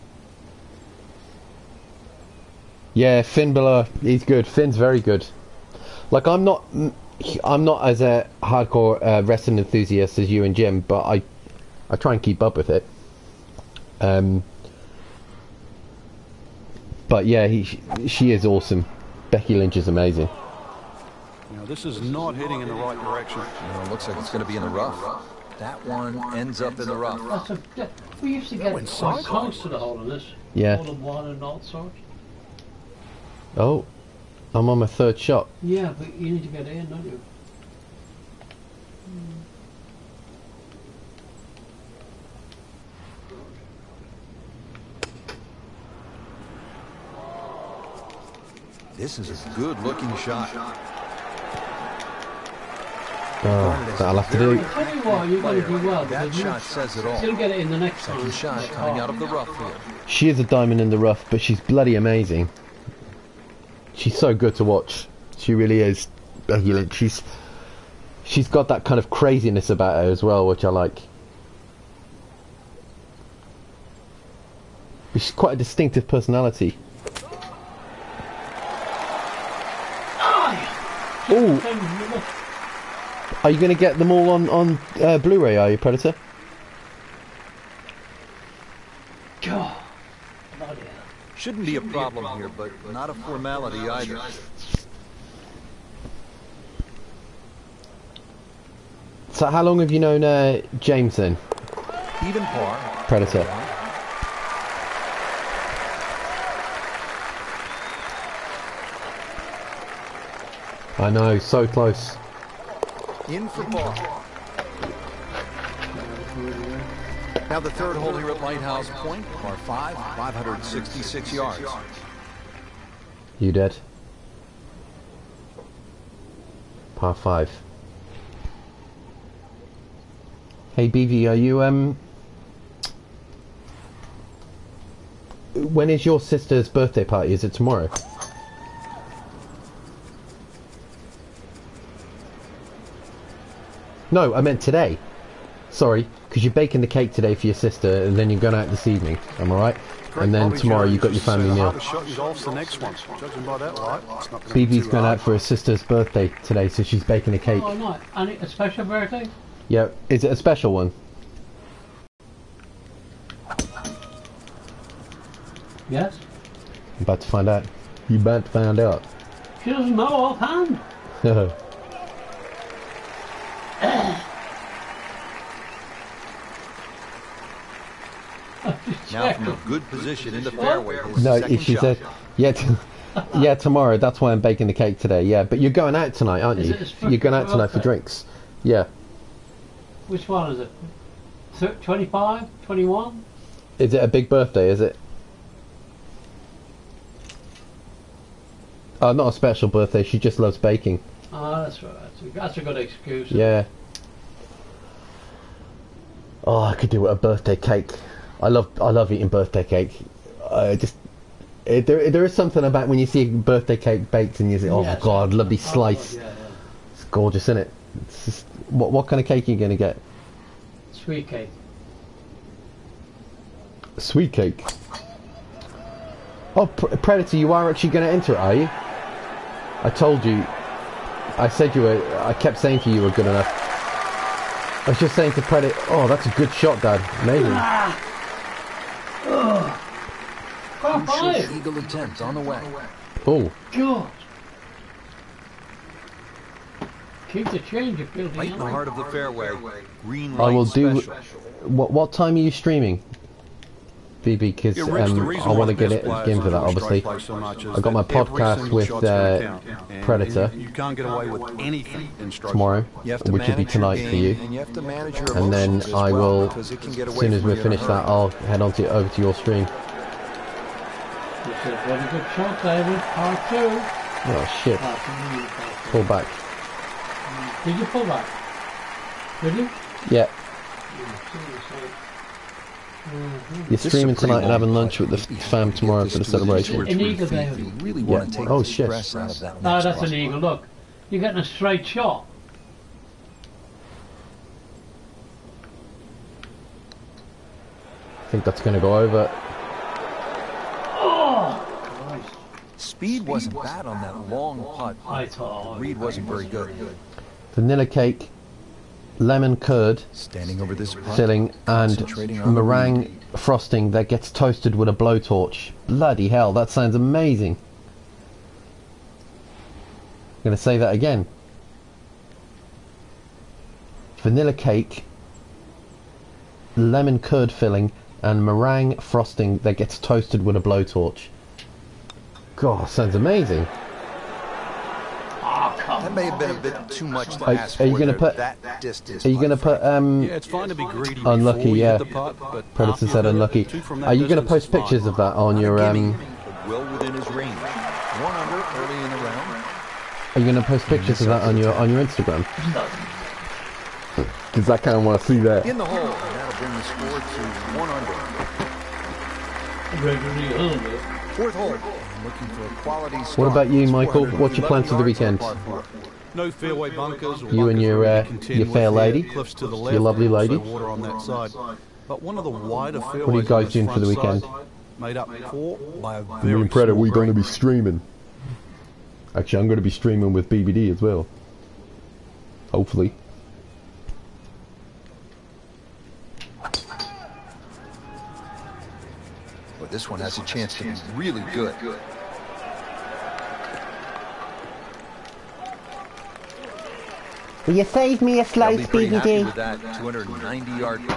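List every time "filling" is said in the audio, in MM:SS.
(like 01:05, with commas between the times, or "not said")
05:11, 05:27.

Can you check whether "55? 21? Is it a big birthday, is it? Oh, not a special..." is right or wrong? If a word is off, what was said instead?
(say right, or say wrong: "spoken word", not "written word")
wrong: "25", not "55".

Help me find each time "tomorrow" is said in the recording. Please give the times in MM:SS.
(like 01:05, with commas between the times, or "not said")
02:17, 02:30, 03:03, 04:22, 04:45.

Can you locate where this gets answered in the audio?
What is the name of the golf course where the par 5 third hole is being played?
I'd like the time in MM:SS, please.
01:58.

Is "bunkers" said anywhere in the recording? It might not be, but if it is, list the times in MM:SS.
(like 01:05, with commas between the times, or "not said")
06:06.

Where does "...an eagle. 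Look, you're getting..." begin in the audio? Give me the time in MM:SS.
04:50.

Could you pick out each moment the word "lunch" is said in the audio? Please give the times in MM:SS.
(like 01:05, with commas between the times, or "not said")
04:44.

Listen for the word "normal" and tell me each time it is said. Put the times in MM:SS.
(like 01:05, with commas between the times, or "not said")
not said.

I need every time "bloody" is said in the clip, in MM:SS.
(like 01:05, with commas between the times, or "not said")
01:01, 05:15.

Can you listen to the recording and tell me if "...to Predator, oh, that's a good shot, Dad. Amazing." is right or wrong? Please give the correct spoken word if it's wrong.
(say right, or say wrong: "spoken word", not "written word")
right.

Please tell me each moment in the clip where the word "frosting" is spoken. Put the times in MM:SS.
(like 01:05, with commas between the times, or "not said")
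05:13, 05:28.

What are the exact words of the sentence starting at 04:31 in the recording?
Good, what a good shot, David.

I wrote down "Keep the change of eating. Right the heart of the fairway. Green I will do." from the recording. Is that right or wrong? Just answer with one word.
wrong.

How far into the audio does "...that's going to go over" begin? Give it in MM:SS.
04:58.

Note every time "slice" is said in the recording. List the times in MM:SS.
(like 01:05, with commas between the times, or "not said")
03:35, 06:38.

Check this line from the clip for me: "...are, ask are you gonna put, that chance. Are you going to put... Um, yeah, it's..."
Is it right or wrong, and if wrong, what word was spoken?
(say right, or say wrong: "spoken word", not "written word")
wrong: "distance", not "chance".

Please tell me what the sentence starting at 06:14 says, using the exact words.
Made up for by a very and Predator, we're going to be streaming.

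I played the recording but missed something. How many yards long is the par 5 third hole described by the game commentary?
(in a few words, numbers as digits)
566.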